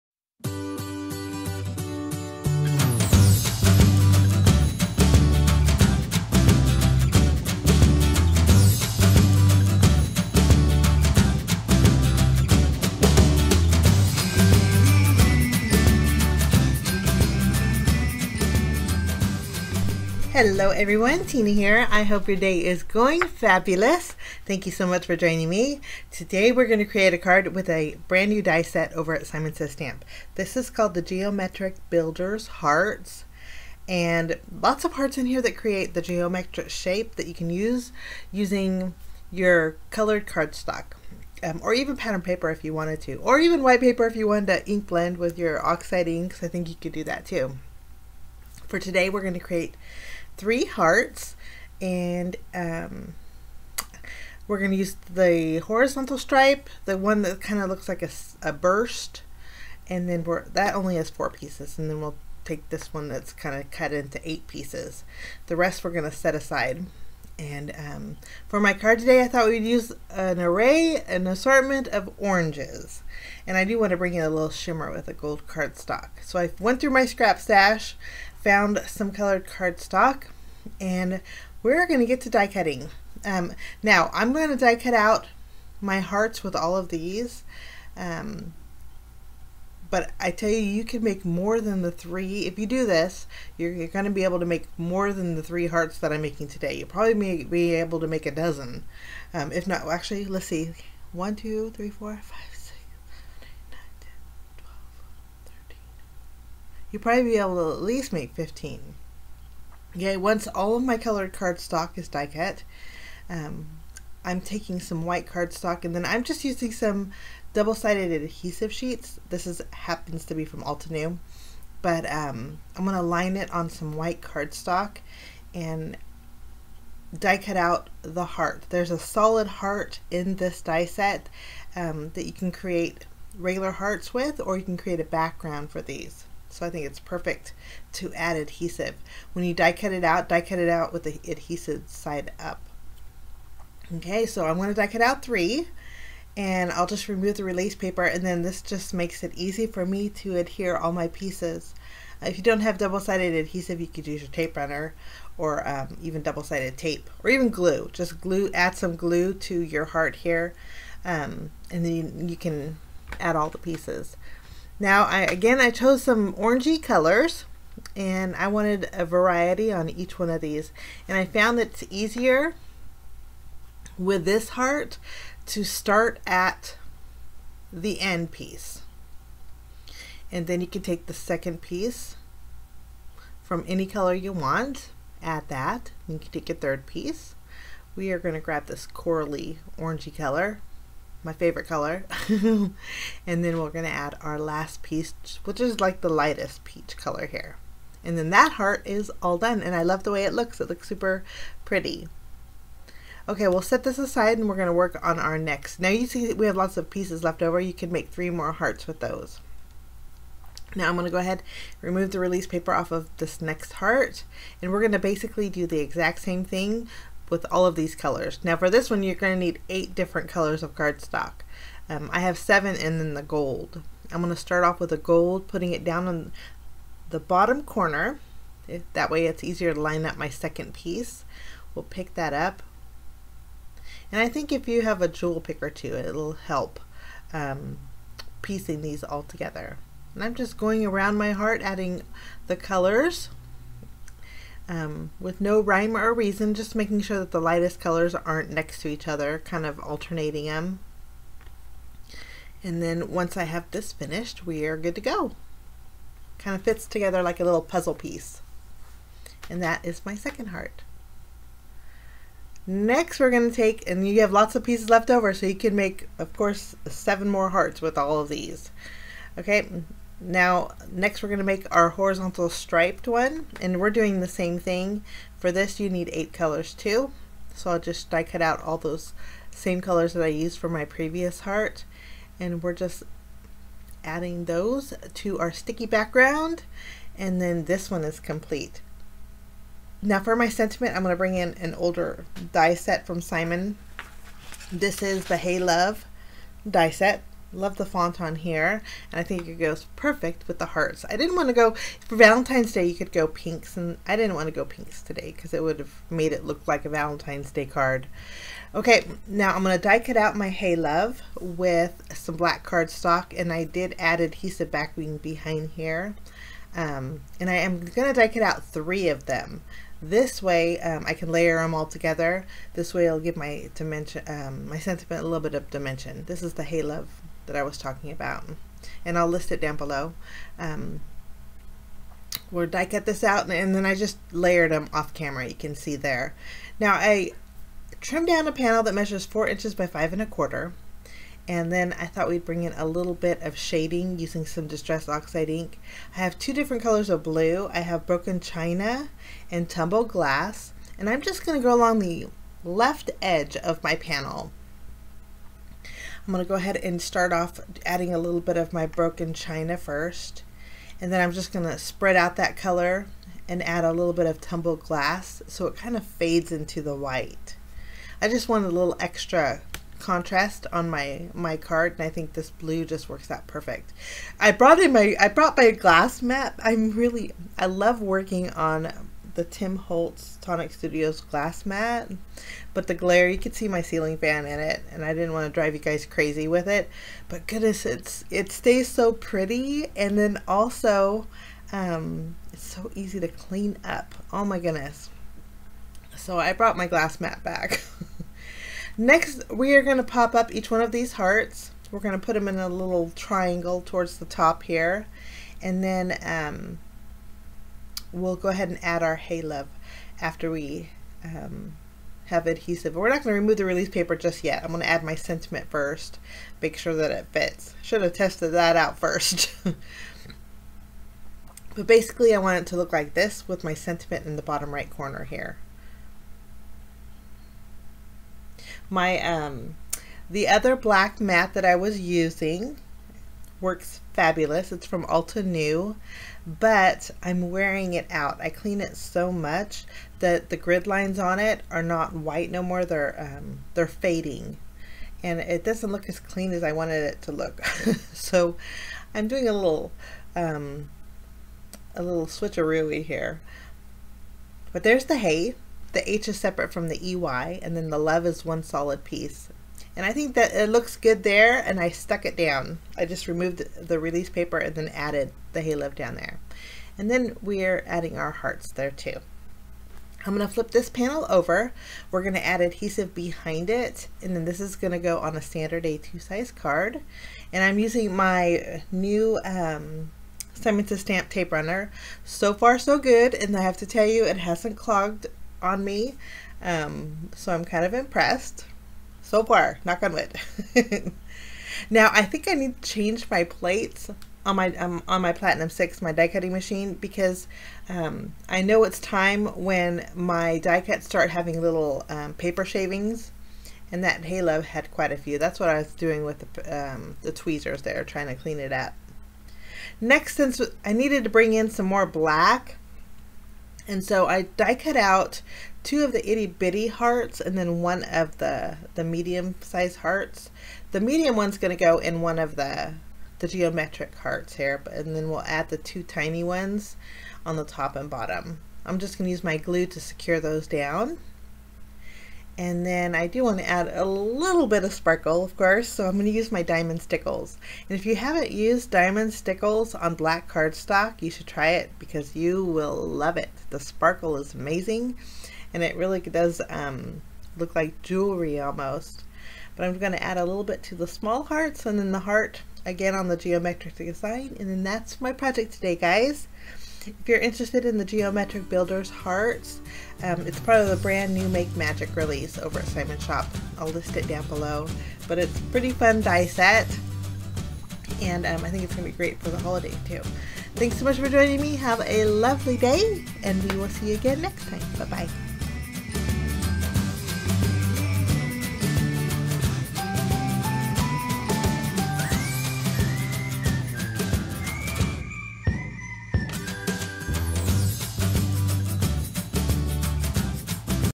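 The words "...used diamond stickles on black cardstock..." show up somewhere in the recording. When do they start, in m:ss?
8:58.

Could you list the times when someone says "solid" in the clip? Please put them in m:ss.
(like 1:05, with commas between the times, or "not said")
2:08, 7:38.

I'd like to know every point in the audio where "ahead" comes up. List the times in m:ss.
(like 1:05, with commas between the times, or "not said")
3:31, 5:56, 6:48.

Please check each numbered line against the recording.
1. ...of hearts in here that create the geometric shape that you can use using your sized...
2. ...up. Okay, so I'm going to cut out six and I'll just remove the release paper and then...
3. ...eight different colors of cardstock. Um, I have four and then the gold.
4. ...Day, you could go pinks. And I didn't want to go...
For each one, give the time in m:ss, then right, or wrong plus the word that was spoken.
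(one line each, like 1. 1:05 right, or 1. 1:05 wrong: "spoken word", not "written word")
1. 0:34 wrong: "colored", not "sized"
2. 2:22 wrong: "three", not "six"
3. 3:39 wrong: "seven", not "four"
4. 5:02 right.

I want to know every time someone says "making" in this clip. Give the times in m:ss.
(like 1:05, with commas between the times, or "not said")
1:36, 4:06.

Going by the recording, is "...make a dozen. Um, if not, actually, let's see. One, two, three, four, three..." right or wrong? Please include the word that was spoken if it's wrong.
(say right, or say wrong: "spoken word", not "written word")
wrong: "five", not "three".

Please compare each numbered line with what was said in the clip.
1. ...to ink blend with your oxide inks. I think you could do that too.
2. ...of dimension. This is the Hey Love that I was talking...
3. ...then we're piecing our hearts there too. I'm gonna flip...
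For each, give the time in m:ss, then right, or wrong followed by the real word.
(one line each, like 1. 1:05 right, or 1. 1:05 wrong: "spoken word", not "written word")
1. 0:44 right
2. 5:25 right
3. 7:47 wrong: "adding", not "piecing".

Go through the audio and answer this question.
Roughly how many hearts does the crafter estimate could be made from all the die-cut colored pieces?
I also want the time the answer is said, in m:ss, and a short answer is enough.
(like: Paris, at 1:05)
15, at 1:48.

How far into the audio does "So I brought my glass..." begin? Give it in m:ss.
6:36.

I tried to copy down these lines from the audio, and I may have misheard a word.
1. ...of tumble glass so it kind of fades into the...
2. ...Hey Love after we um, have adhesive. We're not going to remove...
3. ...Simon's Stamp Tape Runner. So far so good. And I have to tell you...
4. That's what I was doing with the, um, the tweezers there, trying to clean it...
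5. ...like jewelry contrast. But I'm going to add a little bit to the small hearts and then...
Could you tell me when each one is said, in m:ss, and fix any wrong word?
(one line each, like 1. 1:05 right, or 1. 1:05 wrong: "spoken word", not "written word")
1. 6:04 right
2. 6:49 right
3. 8:00 right
4. 8:25 right
5. 9:07 wrong: "almost", not "contrast".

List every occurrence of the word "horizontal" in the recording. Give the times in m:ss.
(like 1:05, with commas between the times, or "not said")
0:55, 4:31.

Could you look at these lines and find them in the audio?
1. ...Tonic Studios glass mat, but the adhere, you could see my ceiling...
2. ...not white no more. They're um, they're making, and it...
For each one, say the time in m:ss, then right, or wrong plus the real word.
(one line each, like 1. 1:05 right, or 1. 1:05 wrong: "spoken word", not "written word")
1. 6:20 wrong: "glare", not "adhere"
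2. 7:21 wrong: "fading", not "making".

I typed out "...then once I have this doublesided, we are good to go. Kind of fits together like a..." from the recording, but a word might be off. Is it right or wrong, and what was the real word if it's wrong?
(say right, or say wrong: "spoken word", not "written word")
wrong: "finished", not "doublesided".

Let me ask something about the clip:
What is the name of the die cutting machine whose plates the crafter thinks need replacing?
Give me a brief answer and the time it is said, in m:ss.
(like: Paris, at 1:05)
Platinum 6, at 8:15.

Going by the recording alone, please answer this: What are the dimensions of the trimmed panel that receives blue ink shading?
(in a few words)
4 by 5 1/4 inches.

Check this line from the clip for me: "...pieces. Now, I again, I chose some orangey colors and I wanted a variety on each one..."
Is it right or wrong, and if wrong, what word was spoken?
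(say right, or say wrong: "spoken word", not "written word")
right.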